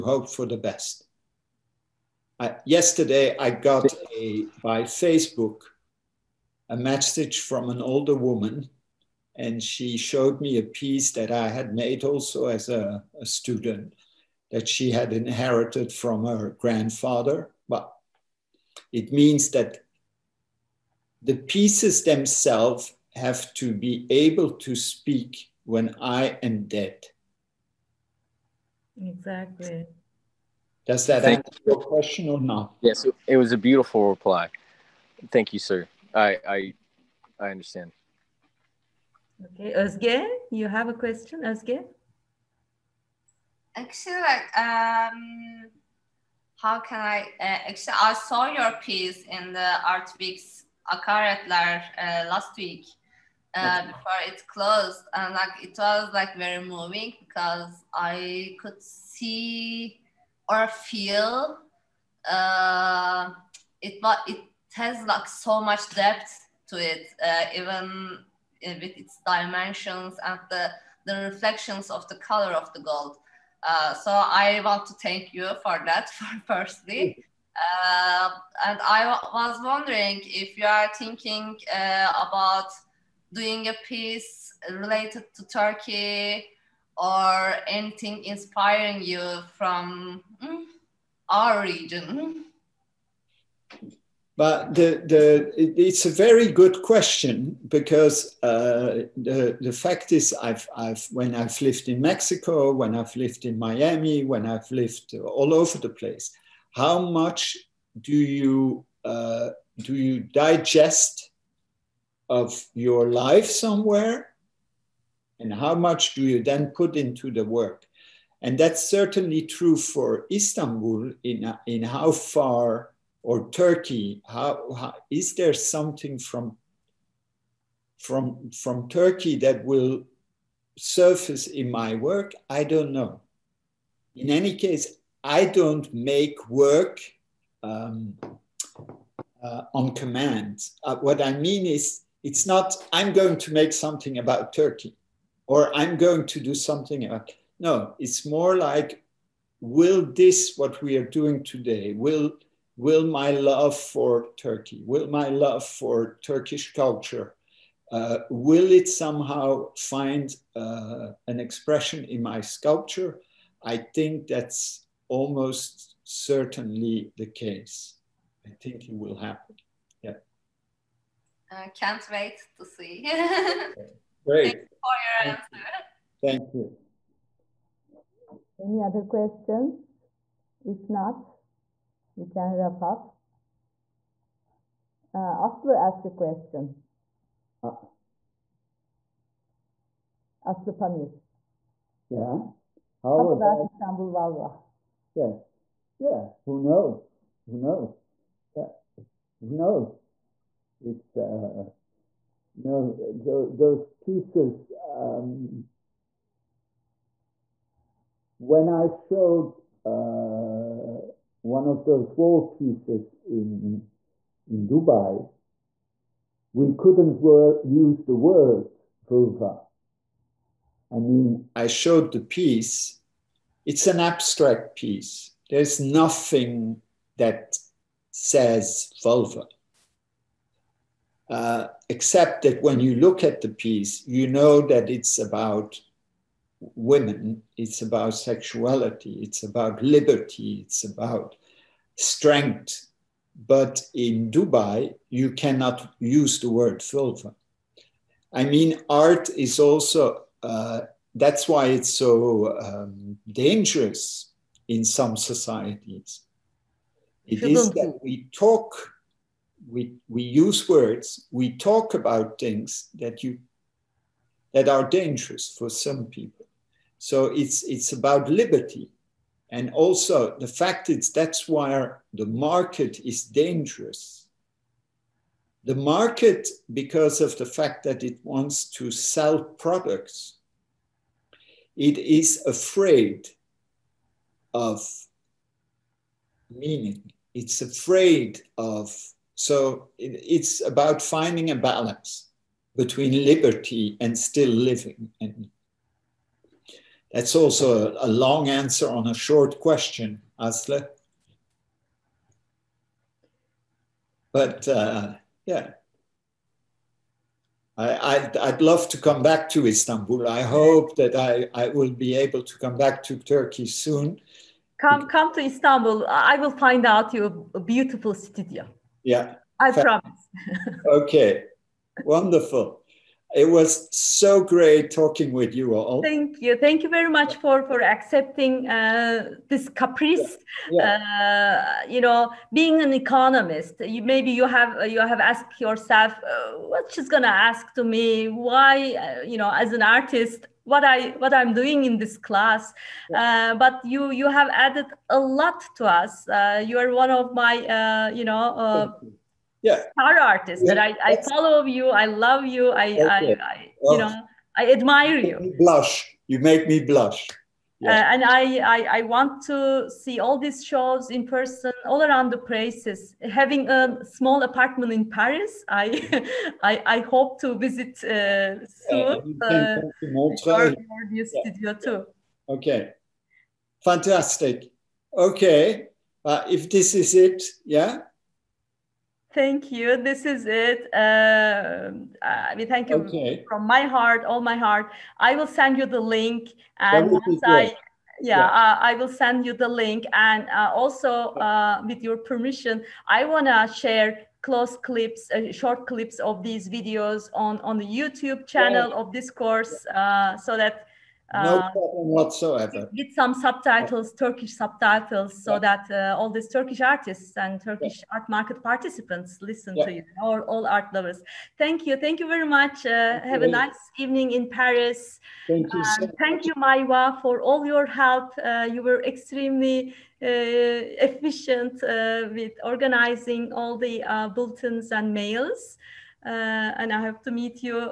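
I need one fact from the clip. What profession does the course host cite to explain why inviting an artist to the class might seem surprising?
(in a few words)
economist.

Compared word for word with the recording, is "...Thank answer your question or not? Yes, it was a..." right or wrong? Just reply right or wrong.
right.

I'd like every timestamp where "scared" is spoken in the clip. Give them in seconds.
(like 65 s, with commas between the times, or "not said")
not said.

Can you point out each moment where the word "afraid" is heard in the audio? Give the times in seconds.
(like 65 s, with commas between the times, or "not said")
282 s, 287 s.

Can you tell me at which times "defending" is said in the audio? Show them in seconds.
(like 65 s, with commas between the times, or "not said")
not said.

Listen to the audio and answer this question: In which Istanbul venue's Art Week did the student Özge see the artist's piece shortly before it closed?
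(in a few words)
Akaretler.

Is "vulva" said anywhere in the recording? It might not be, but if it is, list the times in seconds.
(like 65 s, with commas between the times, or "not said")
194 s, 219 s, 229 s, 246 s.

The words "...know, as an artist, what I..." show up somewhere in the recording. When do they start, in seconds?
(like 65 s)
339 s.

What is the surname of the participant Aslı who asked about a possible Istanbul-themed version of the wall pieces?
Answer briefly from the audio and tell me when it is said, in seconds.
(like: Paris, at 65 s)
Pamir, at 190 s.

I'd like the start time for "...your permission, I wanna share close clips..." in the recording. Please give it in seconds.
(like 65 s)
392 s.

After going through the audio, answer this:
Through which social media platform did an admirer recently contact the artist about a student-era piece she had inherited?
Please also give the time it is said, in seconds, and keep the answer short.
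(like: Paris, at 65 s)
Facebook, at 4 s.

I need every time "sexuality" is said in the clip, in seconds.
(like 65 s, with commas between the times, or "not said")
238 s.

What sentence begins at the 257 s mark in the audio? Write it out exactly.
It is that we talk, we, we use words, we talk about things that you that are dangerous for some people.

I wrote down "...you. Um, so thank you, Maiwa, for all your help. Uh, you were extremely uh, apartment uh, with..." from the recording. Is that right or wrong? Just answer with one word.
wrong.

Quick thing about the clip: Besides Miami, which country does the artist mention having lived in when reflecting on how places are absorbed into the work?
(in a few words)
Mexico.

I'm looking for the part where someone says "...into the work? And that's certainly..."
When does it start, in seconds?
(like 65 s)
116 s.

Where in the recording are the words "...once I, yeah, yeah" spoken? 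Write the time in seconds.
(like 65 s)
387 s.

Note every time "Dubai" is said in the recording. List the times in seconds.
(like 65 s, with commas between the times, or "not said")
214 s, 244 s.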